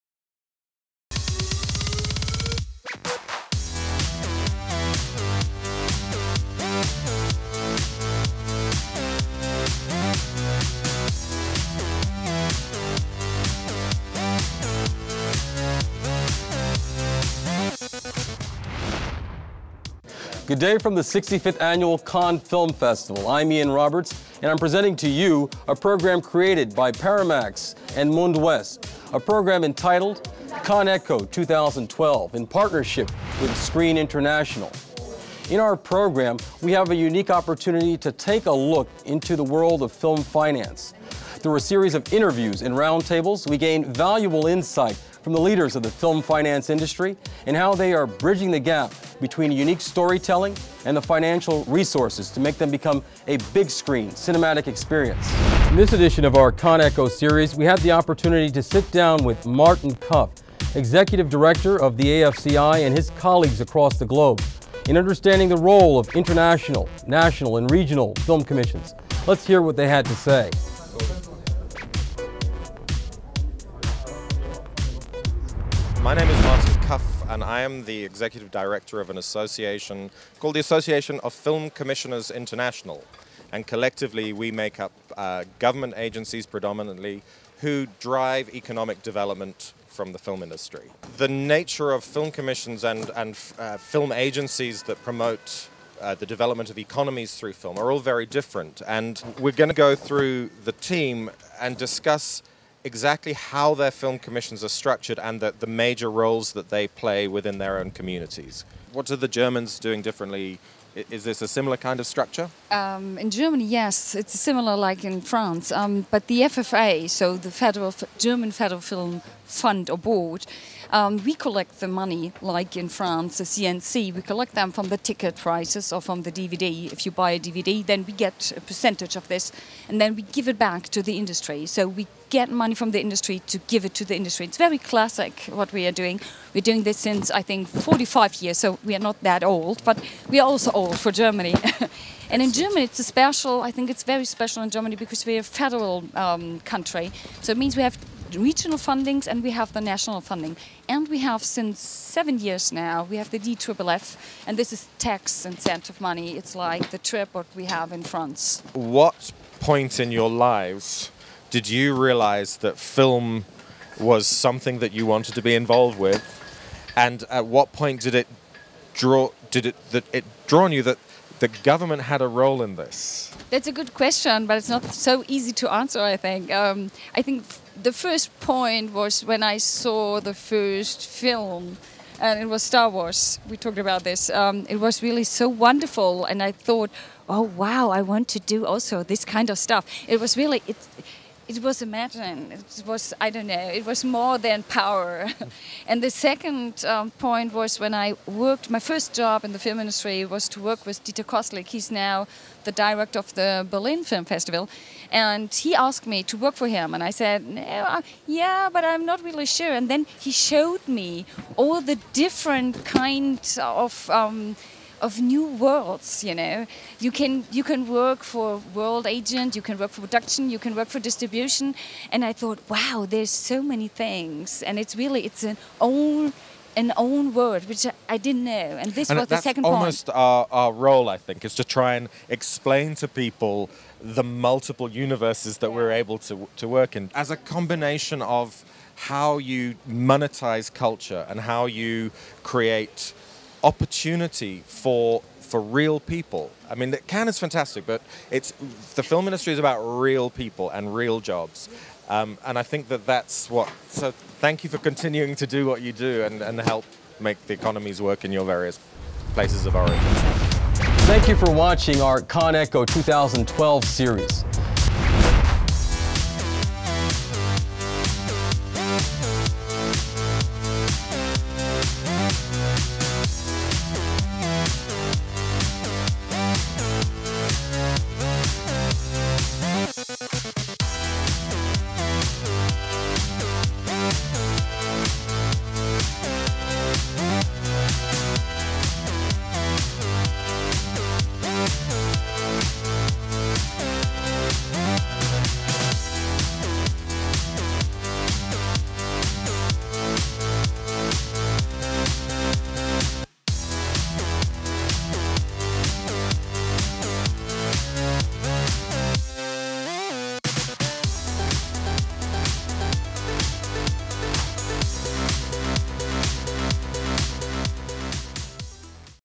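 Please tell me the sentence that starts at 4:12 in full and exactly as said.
Um, and I think that that's what.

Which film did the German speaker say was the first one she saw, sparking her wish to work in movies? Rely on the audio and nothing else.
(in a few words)
Star Wars.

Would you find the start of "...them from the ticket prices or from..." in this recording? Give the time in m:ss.
2:04.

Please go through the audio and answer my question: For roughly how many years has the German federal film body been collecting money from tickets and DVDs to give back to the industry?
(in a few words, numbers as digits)
45.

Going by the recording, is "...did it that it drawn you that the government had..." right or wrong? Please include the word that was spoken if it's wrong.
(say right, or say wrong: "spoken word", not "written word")
right.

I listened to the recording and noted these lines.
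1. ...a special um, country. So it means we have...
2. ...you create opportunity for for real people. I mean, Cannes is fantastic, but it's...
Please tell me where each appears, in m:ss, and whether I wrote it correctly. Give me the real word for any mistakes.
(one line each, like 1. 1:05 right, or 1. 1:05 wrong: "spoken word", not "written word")
1. 2:25 wrong: "federal", not "special"
2. 4:01 right.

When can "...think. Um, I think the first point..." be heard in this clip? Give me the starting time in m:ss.
2:56.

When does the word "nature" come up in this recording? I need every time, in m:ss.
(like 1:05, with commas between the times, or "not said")
1:31.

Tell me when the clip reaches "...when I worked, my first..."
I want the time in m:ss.
3:17.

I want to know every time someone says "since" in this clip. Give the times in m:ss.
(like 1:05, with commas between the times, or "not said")
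2:16, 2:31.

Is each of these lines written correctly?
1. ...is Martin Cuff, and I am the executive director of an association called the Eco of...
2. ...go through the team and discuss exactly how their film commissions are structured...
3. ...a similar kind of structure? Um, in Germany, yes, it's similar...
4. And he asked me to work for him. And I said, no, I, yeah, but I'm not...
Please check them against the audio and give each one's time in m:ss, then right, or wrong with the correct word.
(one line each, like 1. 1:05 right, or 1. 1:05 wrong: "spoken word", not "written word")
1. 1:16 wrong: "Association", not "Eco"
2. 1:39 right
3. 1:51 right
4. 3:25 right.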